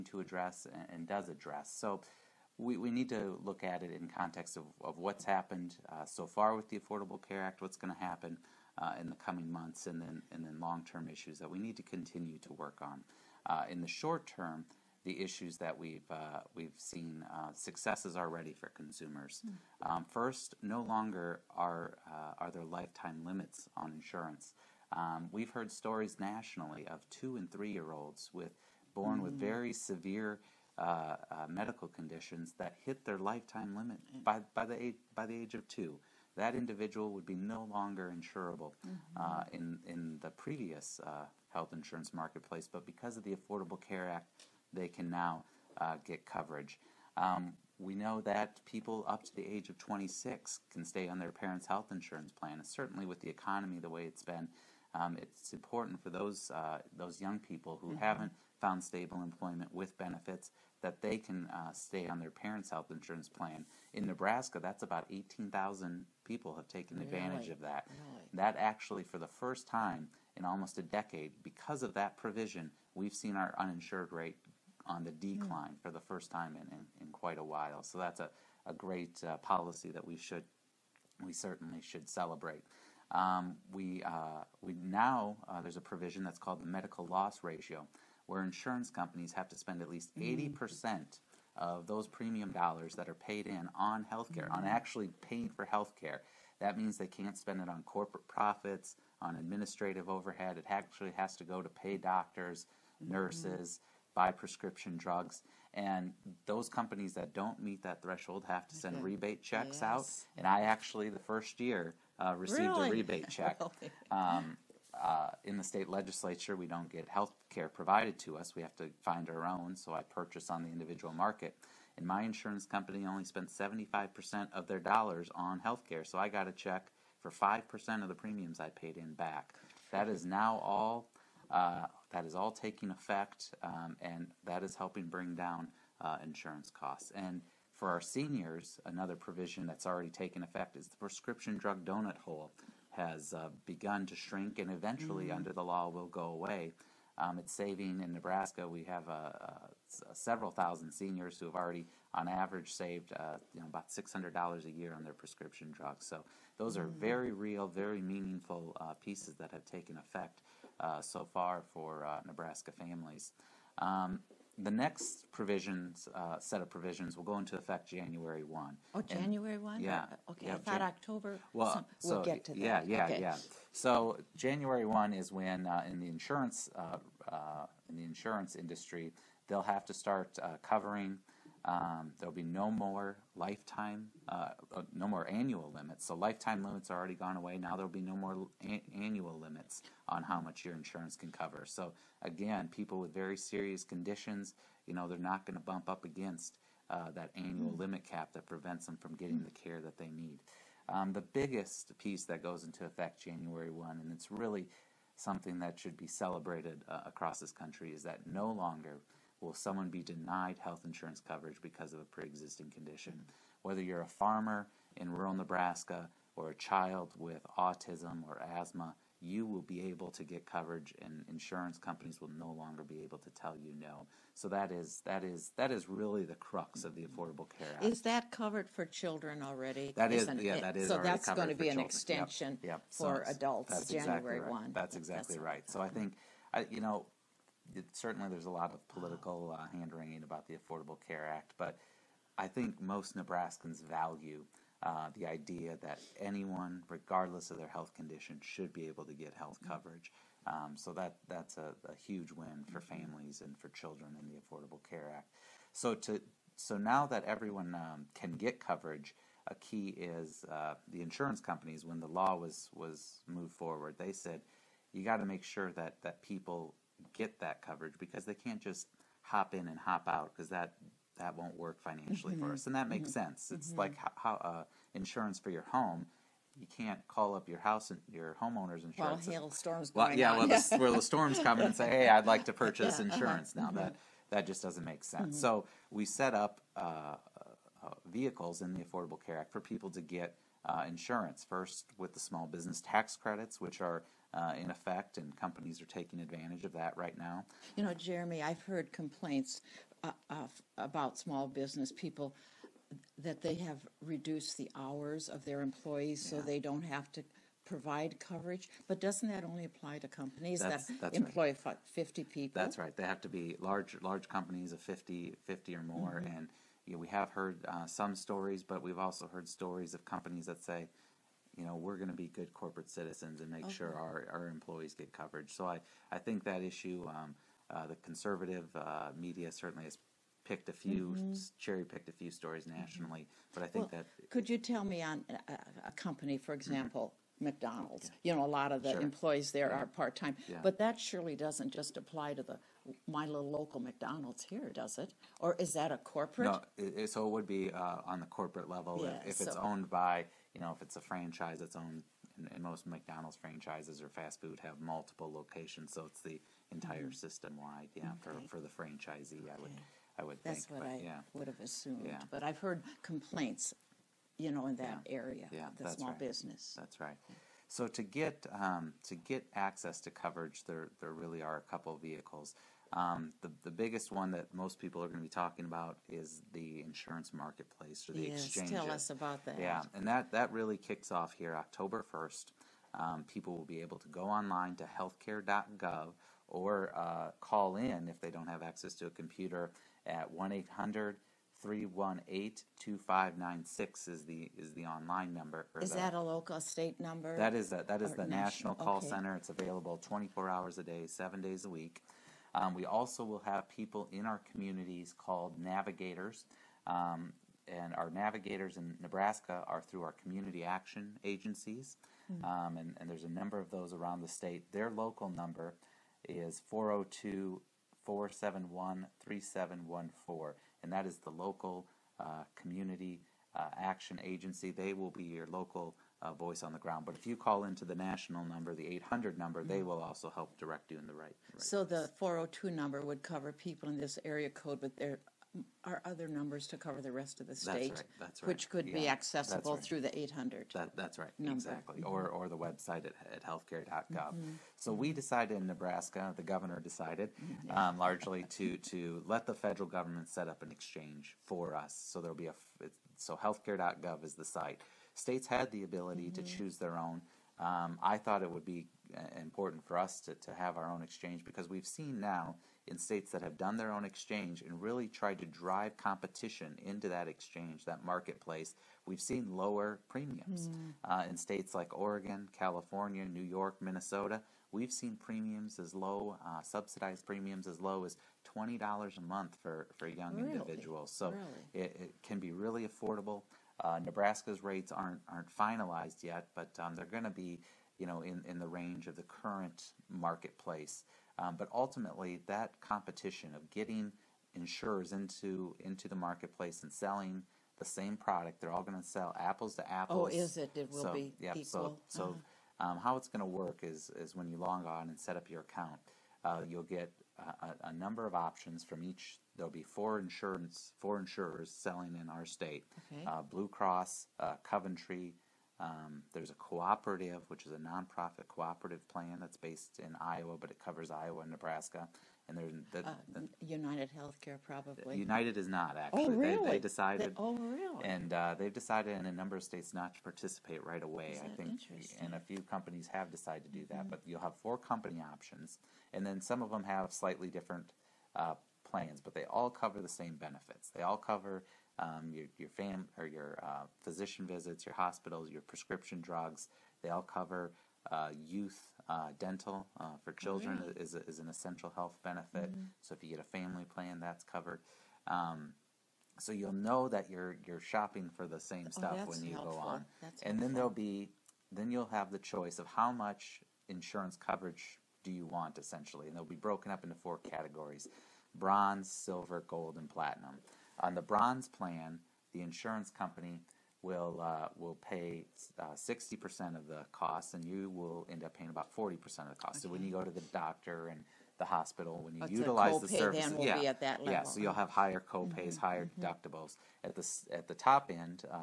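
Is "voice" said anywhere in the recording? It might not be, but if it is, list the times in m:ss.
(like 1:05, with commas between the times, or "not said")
7:06.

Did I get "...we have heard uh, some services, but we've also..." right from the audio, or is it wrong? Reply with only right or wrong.
wrong.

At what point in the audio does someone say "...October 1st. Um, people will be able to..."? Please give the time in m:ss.
6:21.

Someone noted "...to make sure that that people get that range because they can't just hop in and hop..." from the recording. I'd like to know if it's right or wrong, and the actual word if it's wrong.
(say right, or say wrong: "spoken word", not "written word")
wrong: "coverage", not "range".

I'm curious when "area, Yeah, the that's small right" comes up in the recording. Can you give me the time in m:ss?
6:05.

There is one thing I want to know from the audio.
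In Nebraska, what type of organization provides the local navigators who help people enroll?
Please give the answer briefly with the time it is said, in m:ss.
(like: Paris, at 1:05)
community action agencies, at 6:50.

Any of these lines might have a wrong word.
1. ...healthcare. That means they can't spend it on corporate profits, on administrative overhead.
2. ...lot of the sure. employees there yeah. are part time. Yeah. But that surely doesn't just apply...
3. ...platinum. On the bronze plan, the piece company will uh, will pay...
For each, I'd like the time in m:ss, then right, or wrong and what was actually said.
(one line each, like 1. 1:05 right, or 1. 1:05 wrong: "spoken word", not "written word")
1. 1:35 right
2. 5:38 right
3. 9:30 wrong: "insurance", not "piece".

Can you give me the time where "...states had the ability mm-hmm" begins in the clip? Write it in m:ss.
7:35.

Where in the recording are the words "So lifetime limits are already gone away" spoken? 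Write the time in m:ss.
3:06.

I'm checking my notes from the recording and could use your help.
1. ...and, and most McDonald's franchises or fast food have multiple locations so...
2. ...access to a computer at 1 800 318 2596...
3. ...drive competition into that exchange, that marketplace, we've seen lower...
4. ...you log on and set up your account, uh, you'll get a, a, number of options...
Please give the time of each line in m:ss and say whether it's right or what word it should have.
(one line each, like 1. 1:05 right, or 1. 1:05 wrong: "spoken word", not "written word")
1. 5:52 right
2. 6:28 right
3. 7:45 right
4. 8:24 right.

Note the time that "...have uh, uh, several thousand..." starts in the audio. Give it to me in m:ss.
2:28.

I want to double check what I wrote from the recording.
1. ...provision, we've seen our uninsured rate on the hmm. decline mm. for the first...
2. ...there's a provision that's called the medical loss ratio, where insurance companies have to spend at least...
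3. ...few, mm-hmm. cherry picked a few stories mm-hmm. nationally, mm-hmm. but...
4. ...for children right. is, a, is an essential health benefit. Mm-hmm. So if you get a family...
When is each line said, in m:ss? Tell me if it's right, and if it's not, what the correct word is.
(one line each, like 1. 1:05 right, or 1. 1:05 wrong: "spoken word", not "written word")
1. 1:12 right
2. 1:25 right
3. 5:30 right
4. 9:10 right.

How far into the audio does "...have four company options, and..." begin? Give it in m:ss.
8:54.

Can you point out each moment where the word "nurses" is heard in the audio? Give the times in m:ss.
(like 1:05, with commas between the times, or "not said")
1:43.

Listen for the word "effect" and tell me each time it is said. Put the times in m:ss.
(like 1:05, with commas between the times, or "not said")
2:12, 2:20, 2:39, 2:47, 3:22, 4:54.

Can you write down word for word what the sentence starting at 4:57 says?
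You know, Jeremy, I've heard complaints uh, about small business people that they have reduced the hours of their employees yeah.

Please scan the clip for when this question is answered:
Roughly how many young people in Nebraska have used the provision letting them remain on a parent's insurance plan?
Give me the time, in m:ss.
1:05.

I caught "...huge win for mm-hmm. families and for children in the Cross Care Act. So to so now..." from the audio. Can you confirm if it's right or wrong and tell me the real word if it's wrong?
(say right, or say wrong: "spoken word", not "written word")
wrong: "Affordable", not "Cross".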